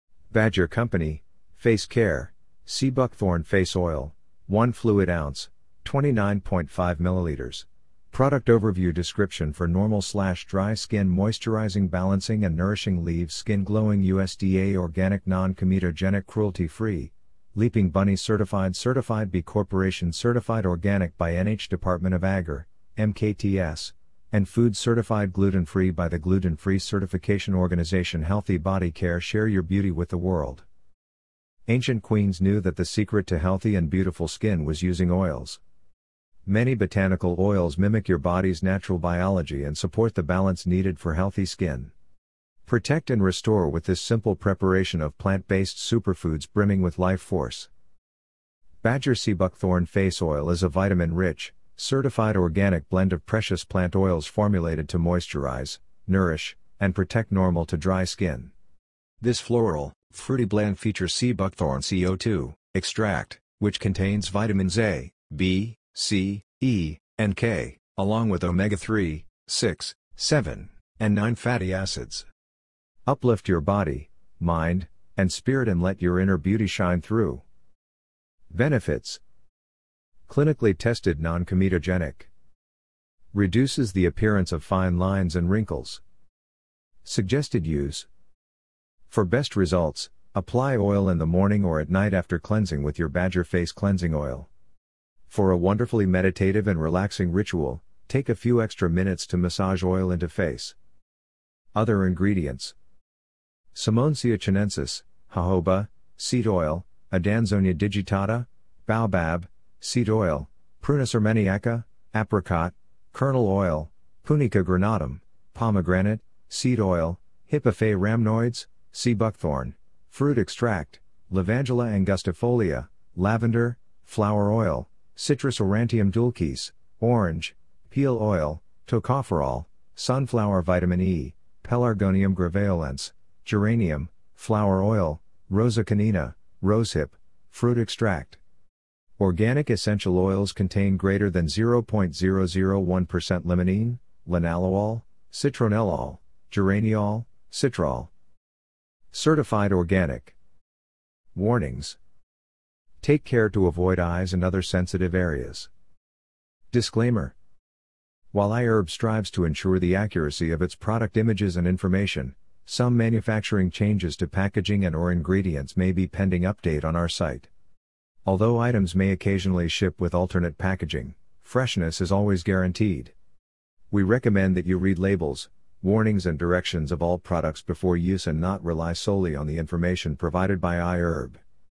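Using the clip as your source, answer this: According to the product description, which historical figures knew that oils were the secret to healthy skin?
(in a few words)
Ancient queens.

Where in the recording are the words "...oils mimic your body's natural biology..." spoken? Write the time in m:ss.
0:37.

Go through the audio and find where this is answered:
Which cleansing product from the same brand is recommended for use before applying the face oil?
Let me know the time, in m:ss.
1:33.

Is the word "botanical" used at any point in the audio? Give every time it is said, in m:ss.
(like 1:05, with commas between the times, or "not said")
0:36.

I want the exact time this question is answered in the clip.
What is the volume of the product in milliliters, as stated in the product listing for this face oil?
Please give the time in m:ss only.
0:05.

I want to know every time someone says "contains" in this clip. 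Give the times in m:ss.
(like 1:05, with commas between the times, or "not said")
1:03, 2:20.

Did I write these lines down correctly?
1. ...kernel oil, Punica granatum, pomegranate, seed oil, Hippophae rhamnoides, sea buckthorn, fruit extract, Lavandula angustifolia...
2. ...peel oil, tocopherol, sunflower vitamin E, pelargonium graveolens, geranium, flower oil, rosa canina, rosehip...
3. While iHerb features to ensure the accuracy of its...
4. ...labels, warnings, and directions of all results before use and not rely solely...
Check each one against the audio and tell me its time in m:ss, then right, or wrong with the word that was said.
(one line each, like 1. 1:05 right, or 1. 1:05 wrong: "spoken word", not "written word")
1. 1:53 right
2. 2:07 right
3. 2:38 wrong: "strives", not "features"
4. 2:54 wrong: "products", not "results".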